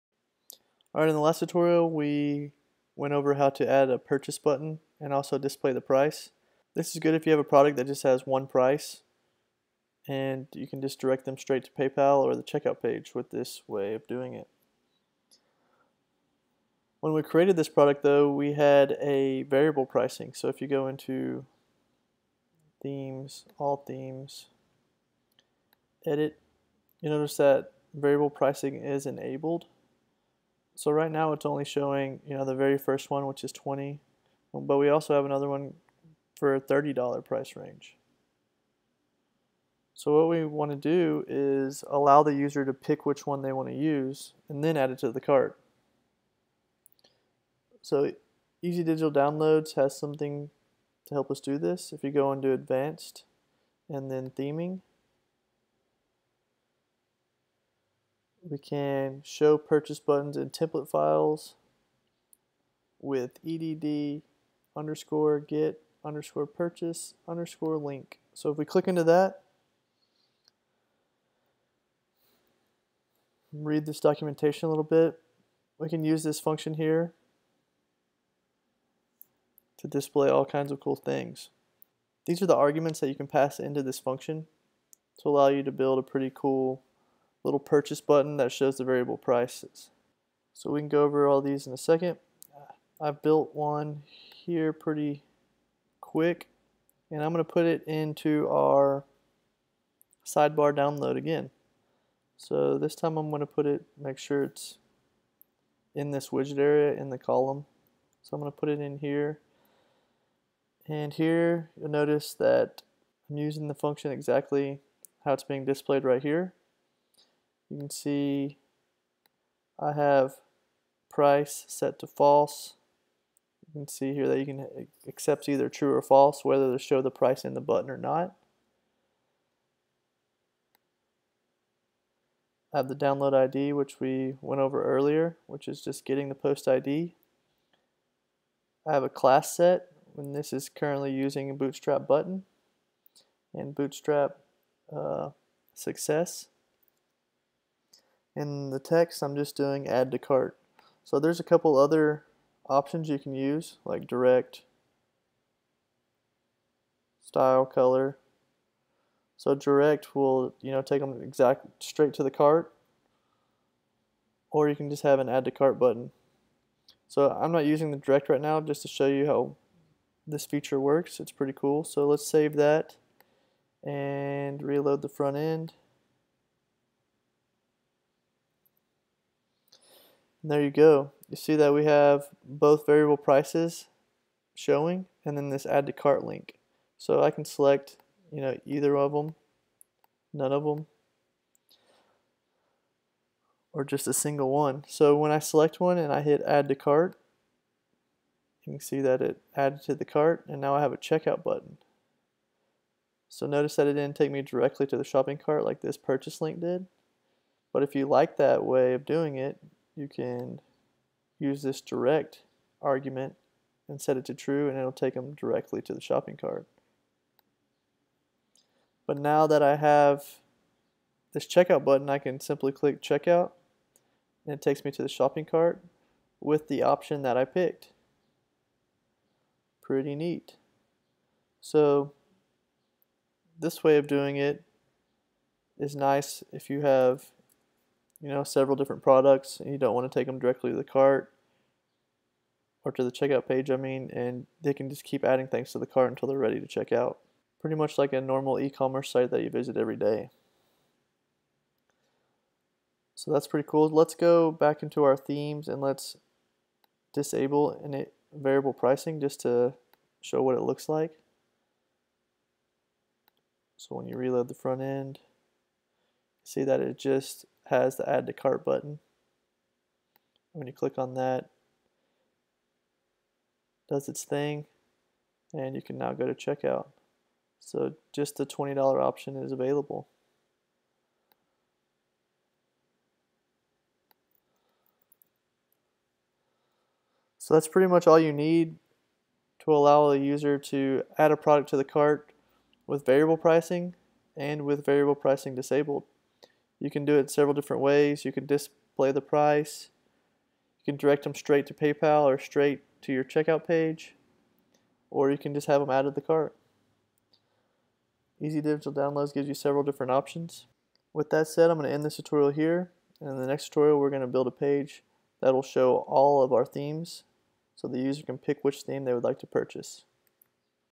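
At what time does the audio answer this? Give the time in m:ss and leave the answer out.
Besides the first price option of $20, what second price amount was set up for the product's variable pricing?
0:36.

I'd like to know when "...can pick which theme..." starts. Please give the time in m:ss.
5:18.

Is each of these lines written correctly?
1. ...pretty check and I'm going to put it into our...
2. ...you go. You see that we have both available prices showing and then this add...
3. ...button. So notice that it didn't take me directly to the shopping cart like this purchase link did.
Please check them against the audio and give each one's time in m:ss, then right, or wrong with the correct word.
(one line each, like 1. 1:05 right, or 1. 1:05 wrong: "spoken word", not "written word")
1. 1:34 wrong: "quick", not "check"
2. 3:00 wrong: "variable", not "available"
3. 3:21 right.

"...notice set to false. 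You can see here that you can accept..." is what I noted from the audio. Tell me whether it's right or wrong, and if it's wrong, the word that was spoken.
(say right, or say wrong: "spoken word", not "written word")
wrong: "price", not "notice".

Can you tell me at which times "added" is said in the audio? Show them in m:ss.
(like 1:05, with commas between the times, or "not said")
3:19.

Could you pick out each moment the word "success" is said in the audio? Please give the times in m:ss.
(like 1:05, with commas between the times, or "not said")
2:25.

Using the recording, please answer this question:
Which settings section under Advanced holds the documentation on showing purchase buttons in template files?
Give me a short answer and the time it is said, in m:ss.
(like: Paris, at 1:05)
Theming, at 0:54.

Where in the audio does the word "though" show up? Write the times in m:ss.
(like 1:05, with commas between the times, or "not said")
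0:18.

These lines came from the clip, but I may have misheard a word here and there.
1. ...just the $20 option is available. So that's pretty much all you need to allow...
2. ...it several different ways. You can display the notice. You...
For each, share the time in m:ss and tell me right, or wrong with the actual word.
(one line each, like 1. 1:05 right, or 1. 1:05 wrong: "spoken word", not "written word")
1. 4:38 right
2. 4:57 wrong: "price", not "notice".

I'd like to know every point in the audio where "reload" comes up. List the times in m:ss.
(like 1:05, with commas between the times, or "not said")
2:54, 4:24.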